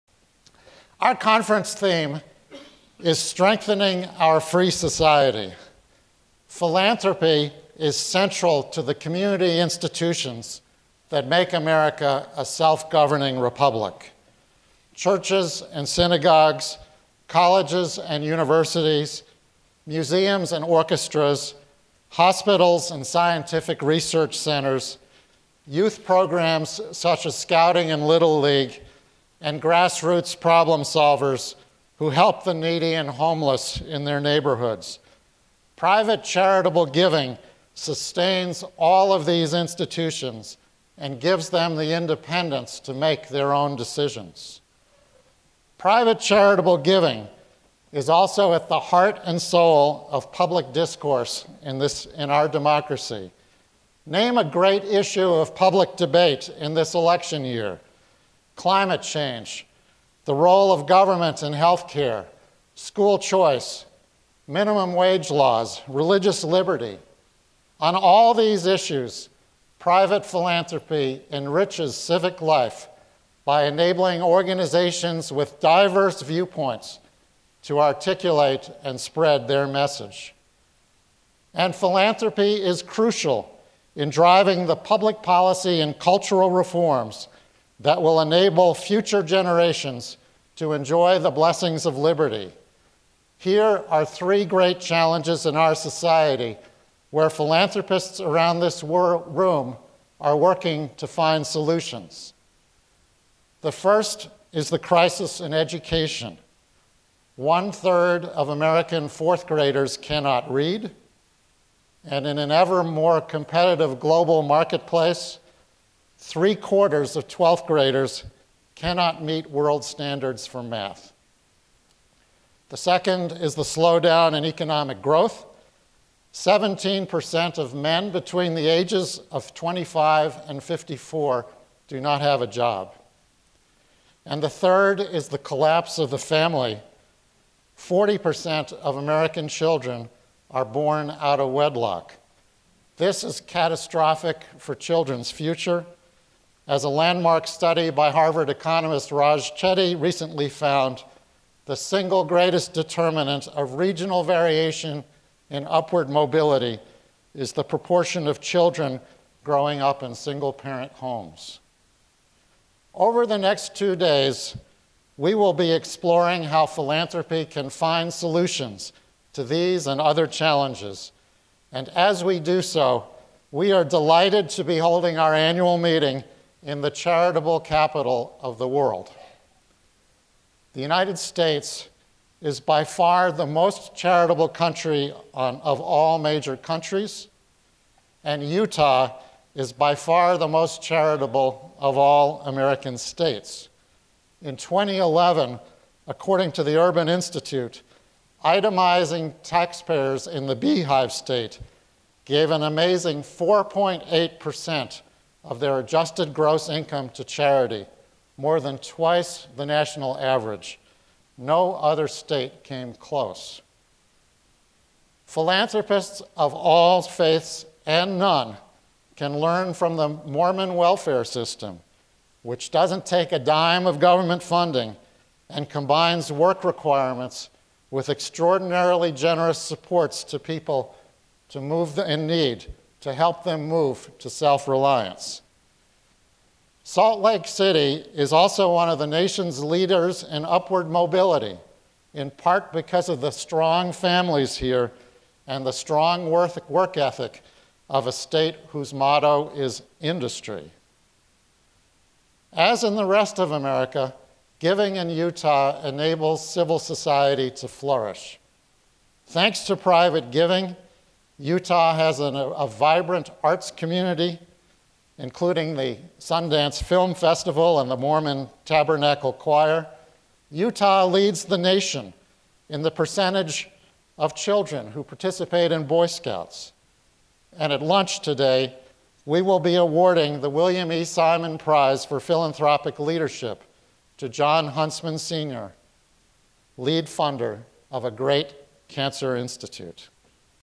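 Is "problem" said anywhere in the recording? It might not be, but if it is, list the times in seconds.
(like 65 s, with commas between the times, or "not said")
30 s.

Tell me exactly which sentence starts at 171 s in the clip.
And as we do so, we are delighted to be holding our annual meeting in the charitable capital of the world.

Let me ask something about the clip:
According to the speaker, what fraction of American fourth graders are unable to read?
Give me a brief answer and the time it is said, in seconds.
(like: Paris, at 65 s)
One third, at 107 s.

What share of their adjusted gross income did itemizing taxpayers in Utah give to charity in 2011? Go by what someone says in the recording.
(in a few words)
4.8%.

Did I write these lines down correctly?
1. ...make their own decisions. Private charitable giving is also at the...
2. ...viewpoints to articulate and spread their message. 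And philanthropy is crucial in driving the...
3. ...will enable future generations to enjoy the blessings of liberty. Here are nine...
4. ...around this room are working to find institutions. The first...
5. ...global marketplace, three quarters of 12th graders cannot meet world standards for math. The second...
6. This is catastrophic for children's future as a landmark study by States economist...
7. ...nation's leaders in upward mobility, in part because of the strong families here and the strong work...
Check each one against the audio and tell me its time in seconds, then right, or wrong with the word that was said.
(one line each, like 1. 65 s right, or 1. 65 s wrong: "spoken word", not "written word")
1. 42 s right
2. 76 s right
3. 88 s wrong: "three", not "nine"
4. 98 s wrong: "solutions", not "institutions"
5. 113 s right
6. 142 s wrong: "Harvard", not "States"
7. 239 s right.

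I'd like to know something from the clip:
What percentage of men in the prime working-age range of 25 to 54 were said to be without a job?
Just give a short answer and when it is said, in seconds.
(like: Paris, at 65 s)
17%, at 126 s.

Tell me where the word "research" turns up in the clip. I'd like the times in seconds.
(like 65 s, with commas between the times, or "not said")
23 s.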